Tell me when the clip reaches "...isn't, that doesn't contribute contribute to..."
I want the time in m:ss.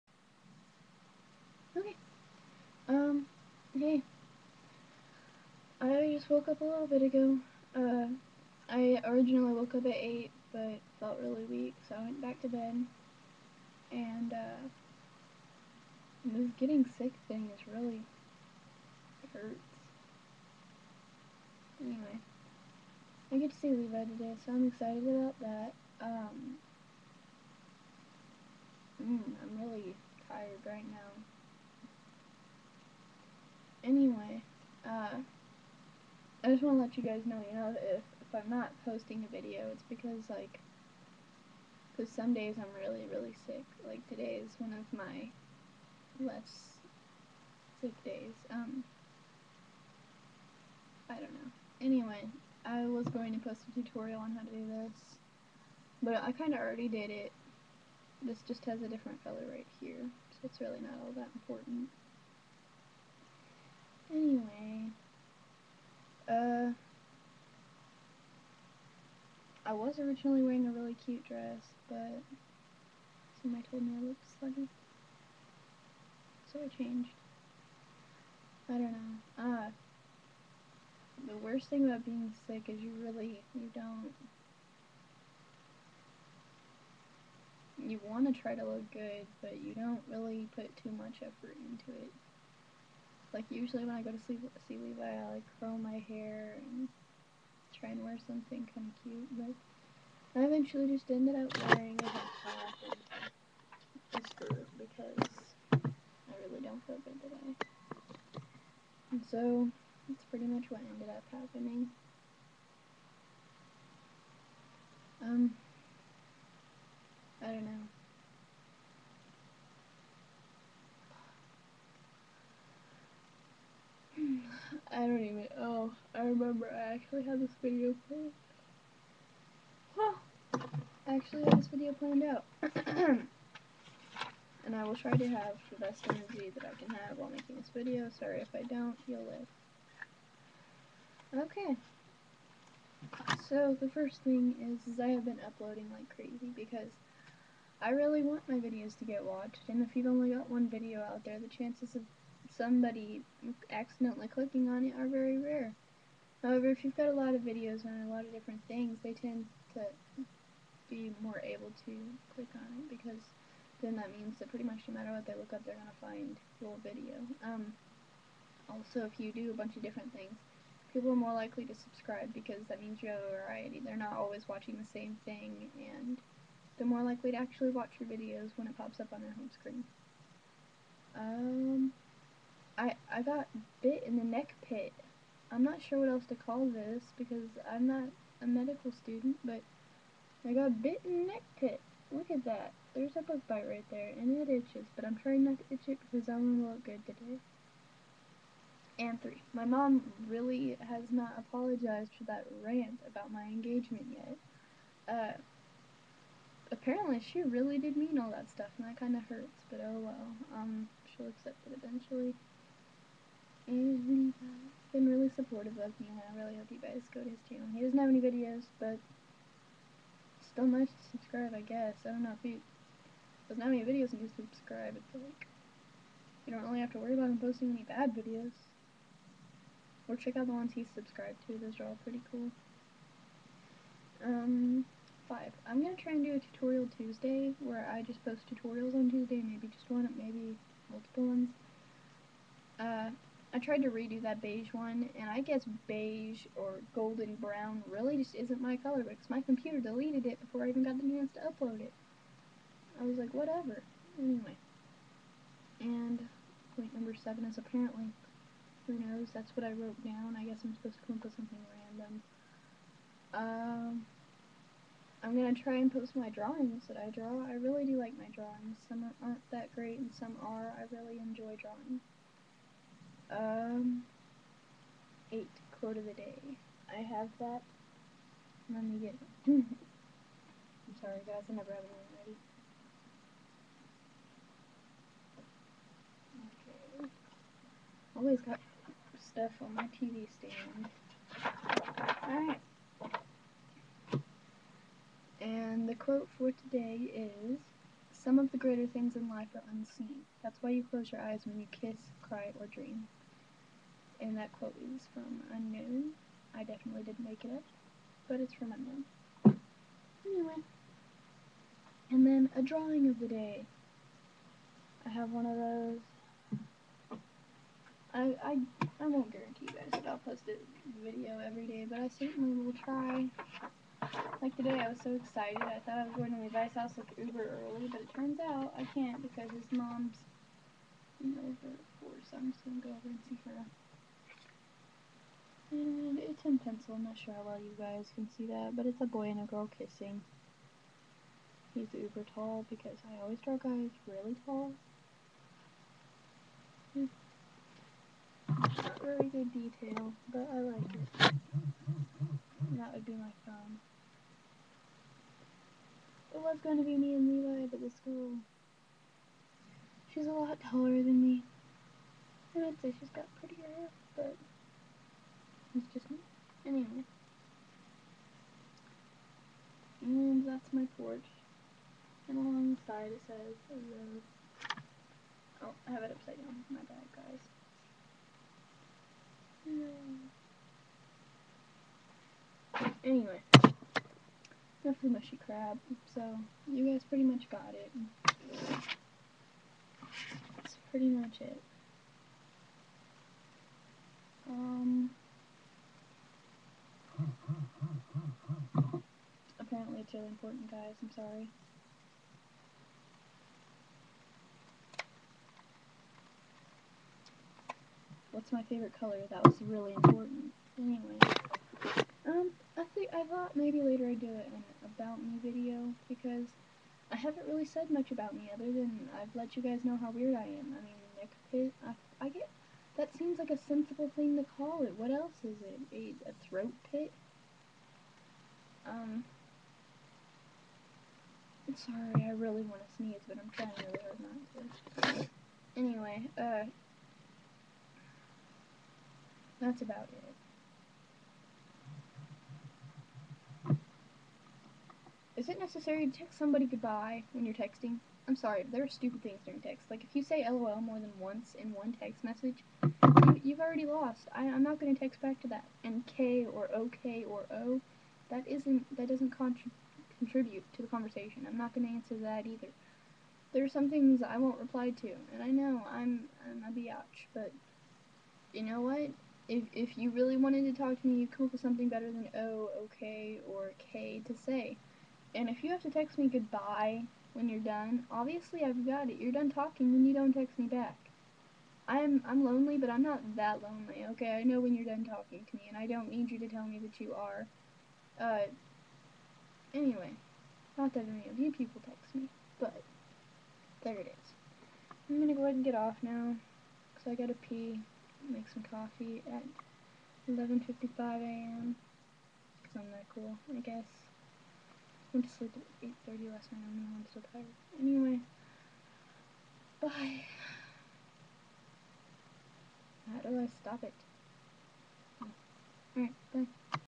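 7:38.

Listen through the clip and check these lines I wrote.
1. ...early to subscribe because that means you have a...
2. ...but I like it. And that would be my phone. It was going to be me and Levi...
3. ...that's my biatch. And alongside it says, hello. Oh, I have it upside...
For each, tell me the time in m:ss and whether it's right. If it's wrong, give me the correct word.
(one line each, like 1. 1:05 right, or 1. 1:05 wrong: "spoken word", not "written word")
1. 2:51 wrong: "likely", not "early"
2. 5:50 right
3. 6:10 wrong: "porch", not "biatch".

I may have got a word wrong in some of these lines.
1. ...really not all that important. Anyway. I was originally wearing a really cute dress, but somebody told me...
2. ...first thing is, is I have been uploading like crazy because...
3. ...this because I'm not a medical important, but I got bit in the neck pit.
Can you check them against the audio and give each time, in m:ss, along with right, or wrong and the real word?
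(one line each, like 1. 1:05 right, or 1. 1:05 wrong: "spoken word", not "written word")
1. 1:00 right
2. 2:23 right
3. 3:06 wrong: "student", not "important".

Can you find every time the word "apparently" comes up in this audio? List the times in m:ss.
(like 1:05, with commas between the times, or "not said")
3:26, 4:17, 6:39.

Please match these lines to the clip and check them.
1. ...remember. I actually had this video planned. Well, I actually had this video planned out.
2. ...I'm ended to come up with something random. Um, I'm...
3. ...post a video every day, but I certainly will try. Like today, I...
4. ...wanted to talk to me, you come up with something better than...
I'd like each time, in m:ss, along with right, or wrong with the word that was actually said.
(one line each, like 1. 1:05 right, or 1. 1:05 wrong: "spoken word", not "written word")
1. 2:06 right
2. 4:20 wrong: "supposed", not "ended"
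3. 5:20 right
4. 7:50 right.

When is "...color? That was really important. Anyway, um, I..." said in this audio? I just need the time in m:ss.
6:48.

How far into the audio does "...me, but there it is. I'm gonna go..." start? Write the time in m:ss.
8:12.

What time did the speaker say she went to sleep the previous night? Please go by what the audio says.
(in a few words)
8:30.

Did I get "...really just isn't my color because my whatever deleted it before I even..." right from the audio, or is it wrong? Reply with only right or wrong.
wrong.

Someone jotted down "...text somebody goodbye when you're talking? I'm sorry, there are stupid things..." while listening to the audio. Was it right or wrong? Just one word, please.
wrong.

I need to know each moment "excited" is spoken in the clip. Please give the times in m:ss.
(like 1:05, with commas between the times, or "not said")
0:24, 5:25.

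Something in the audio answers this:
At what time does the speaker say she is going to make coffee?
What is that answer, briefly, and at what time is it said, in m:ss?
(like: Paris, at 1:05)
11:55 a.m., at 8:20.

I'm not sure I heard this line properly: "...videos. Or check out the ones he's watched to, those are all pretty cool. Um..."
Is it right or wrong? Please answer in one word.
wrong.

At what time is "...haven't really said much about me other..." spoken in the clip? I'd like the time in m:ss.
6:57.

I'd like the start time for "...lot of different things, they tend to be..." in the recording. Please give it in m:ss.
2:38.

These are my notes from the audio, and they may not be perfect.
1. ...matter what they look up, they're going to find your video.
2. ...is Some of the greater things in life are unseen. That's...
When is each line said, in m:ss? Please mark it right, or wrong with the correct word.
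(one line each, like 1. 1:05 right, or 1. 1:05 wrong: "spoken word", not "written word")
1. 2:44 right
2. 4:57 right.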